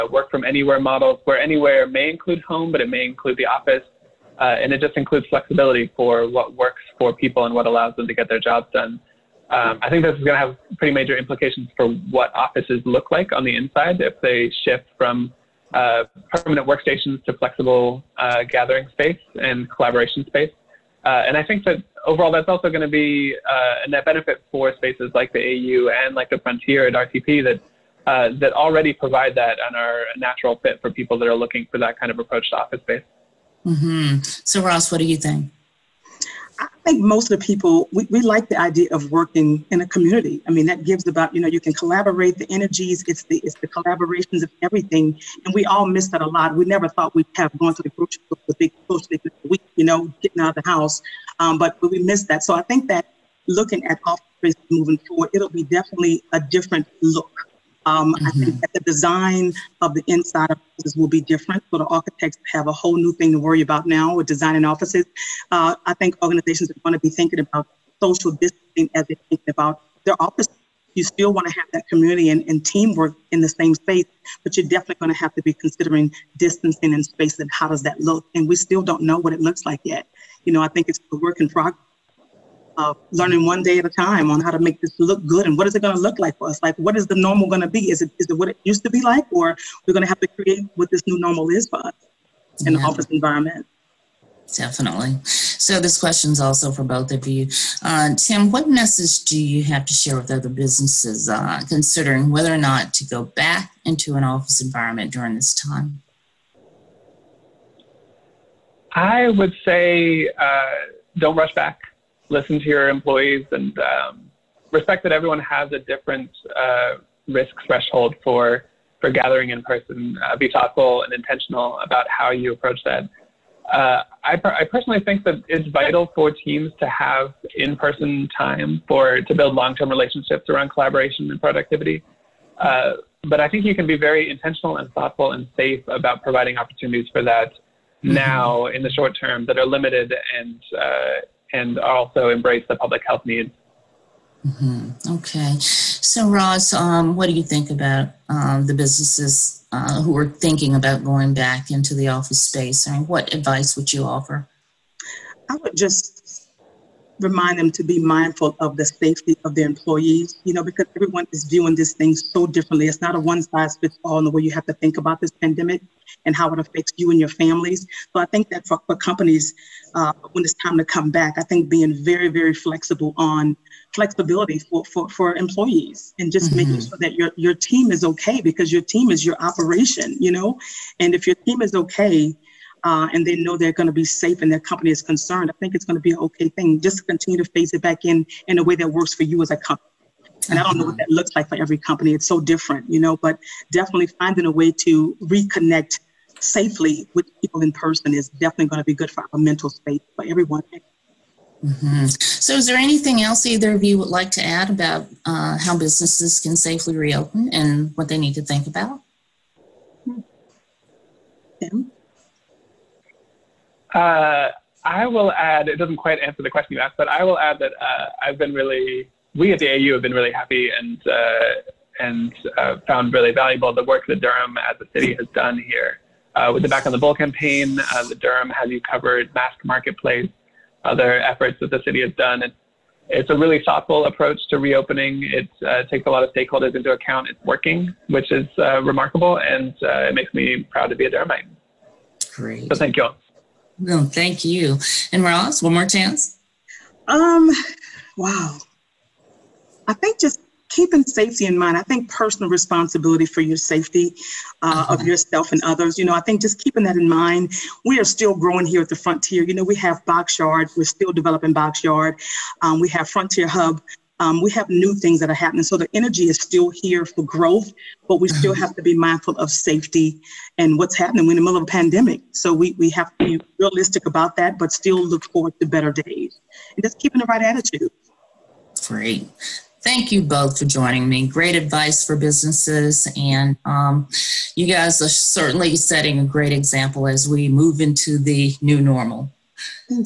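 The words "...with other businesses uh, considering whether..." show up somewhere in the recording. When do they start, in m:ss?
1:40.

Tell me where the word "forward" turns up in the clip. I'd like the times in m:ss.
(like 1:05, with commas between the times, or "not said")
0:55, 4:35.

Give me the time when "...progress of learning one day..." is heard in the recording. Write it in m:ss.
1:21.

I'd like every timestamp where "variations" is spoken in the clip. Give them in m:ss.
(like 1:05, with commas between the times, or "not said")
not said.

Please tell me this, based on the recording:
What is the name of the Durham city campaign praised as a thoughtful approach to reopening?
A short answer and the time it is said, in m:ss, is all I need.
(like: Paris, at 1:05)
Back on the Bull, at 3:46.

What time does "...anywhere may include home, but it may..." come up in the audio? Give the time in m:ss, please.
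0:01.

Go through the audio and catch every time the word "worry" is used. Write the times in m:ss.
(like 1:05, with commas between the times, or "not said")
1:03.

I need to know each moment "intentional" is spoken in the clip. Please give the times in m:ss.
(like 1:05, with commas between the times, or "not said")
2:01, 2:14.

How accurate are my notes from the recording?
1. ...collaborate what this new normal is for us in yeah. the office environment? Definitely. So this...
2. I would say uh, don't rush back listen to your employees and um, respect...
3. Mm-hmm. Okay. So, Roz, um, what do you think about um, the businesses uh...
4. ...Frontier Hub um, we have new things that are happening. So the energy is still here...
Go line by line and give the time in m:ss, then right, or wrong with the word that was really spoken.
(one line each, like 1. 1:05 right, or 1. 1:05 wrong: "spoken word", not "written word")
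1. 1:30 wrong: "create", not "collaborate"
2. 1:48 right
3. 2:24 right
4. 4:23 right.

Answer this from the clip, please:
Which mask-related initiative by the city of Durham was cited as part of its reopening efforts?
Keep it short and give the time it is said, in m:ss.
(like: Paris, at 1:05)
Durham Has You Covered Mask Marketplace, at 3:48.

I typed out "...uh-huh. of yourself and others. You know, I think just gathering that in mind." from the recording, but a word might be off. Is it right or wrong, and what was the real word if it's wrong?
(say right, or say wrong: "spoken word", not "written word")
wrong: "keeping", not "gathering".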